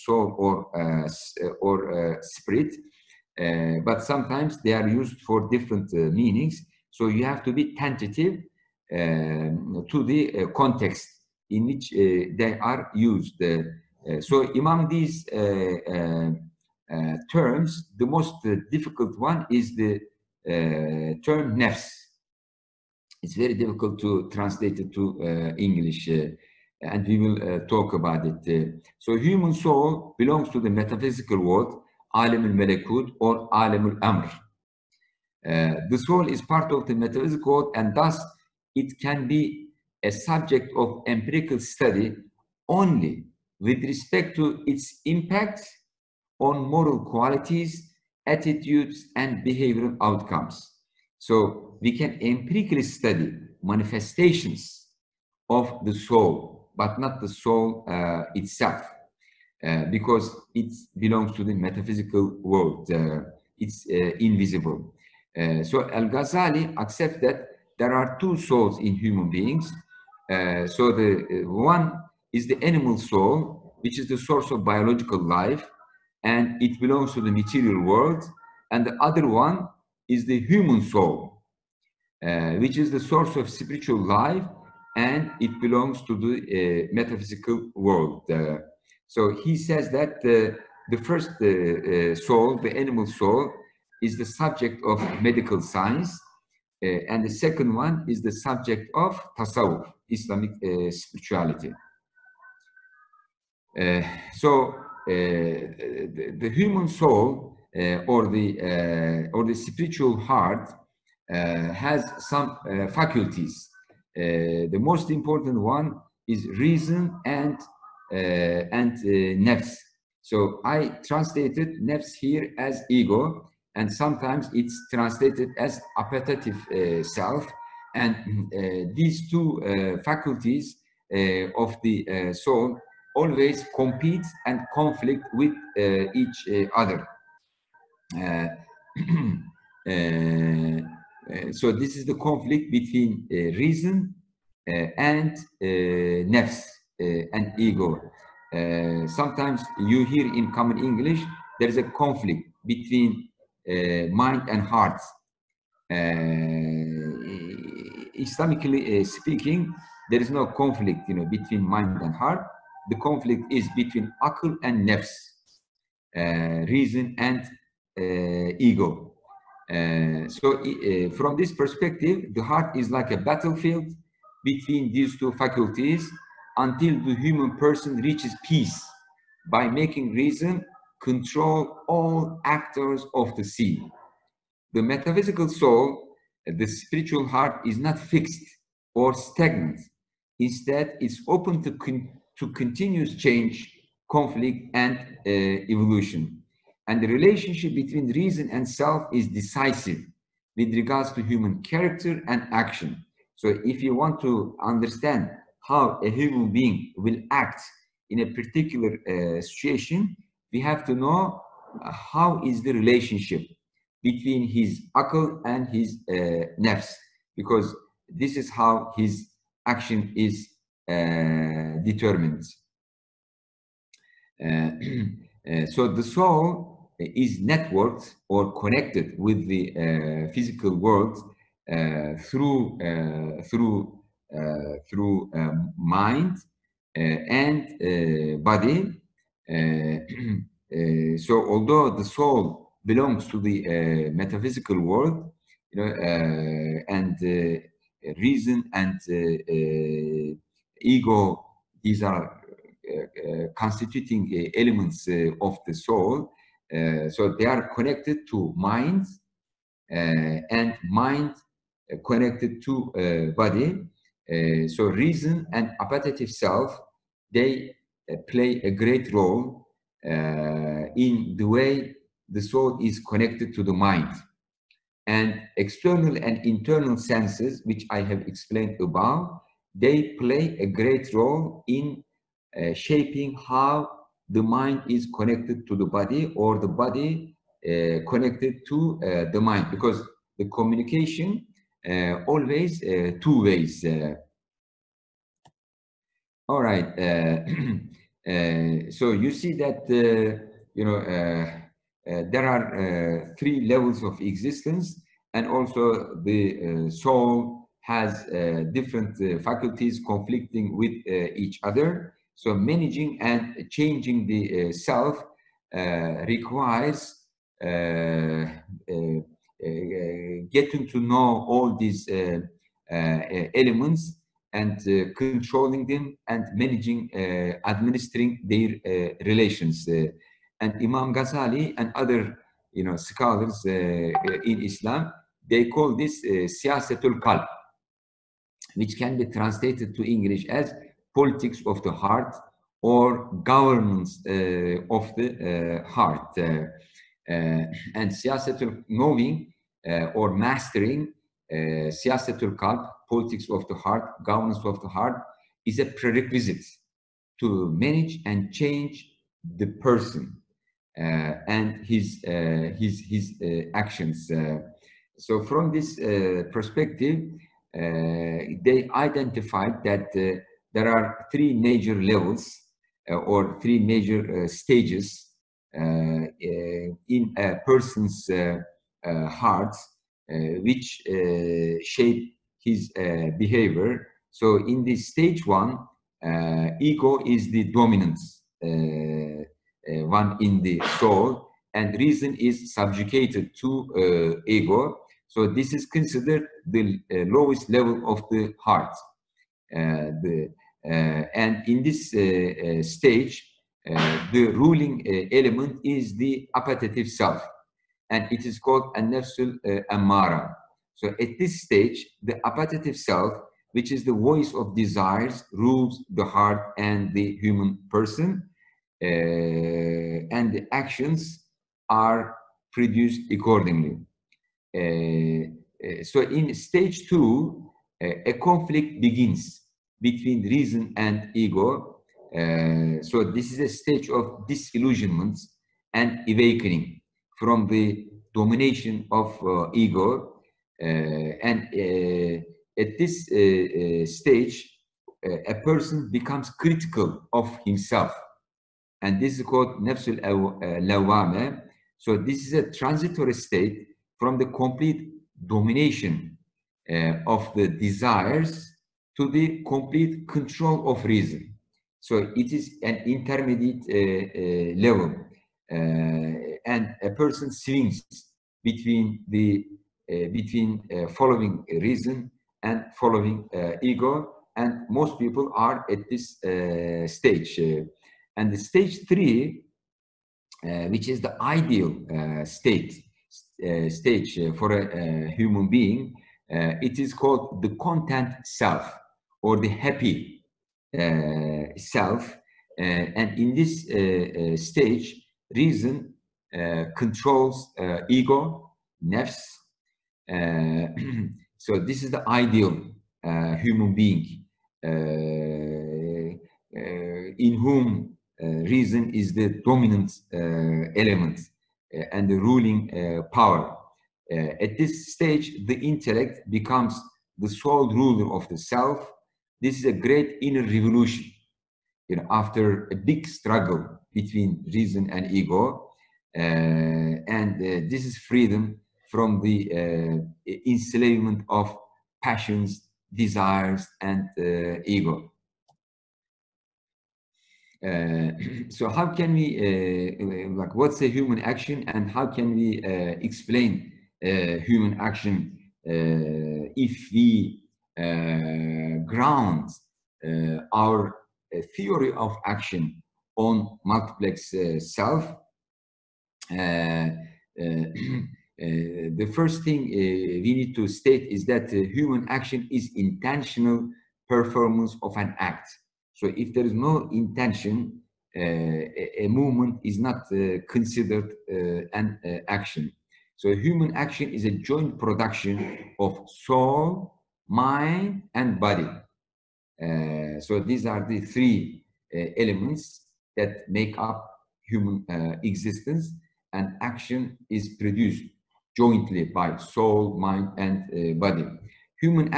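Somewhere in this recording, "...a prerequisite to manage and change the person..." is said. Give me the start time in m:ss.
5:55.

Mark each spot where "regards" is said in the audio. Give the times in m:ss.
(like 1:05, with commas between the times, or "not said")
3:20.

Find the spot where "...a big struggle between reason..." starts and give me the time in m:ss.
8:42.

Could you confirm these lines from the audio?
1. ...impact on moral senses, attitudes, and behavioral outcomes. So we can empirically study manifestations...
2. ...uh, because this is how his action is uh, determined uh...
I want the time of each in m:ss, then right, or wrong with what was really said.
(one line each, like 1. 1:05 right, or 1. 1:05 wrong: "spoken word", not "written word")
1. 0:45 wrong: "qualities", not "senses"
2. 3:36 right.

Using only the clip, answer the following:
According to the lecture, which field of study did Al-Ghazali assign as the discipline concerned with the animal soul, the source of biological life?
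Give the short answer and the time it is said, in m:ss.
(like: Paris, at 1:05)
medical science, at 1:35.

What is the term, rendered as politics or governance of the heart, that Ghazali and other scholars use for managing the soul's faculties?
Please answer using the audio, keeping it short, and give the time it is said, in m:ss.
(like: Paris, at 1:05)
siyasatul qalb, at 5:36.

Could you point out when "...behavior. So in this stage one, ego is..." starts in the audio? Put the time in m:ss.
6:23.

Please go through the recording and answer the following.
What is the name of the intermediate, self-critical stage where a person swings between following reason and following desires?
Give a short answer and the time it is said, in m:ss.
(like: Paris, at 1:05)
nefsul lawame, at 7:29.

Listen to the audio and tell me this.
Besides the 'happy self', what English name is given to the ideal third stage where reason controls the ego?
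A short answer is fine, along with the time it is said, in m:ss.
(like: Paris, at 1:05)
the content self, at 8:07.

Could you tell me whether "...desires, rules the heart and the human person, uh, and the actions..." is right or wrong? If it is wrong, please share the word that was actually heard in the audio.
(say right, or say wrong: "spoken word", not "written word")
right.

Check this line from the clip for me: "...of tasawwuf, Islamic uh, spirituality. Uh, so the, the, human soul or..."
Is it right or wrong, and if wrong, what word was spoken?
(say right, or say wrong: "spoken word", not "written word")
right.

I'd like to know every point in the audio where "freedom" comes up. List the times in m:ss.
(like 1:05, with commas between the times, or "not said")
8:48.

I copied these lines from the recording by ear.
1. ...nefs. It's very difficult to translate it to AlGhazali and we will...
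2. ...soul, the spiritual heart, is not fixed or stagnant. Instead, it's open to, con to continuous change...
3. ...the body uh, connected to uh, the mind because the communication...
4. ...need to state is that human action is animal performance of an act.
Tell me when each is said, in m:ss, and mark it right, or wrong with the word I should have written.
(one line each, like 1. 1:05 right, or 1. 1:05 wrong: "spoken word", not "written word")
1. 0:21 wrong: "English", not "AlGhazali"
2. 3:05 right
3. 4:46 right
4. 9:20 wrong: "intentional", not "animal".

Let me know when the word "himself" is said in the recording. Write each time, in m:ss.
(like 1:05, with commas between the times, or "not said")
7:27.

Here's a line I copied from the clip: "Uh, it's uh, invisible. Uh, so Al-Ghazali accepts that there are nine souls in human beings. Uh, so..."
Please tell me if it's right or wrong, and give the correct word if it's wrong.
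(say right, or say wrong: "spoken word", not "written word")
wrong: "two", not "nine".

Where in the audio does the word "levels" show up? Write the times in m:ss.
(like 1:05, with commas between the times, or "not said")
5:03, 6:12, 6:37, 7:44.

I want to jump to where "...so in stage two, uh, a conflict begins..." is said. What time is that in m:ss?
7:06.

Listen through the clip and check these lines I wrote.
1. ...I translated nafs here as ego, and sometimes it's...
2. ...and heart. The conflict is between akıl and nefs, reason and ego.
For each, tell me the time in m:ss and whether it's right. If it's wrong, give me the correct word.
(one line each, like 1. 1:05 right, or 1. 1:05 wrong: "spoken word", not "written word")
1. 2:00 right
2. 2:42 right.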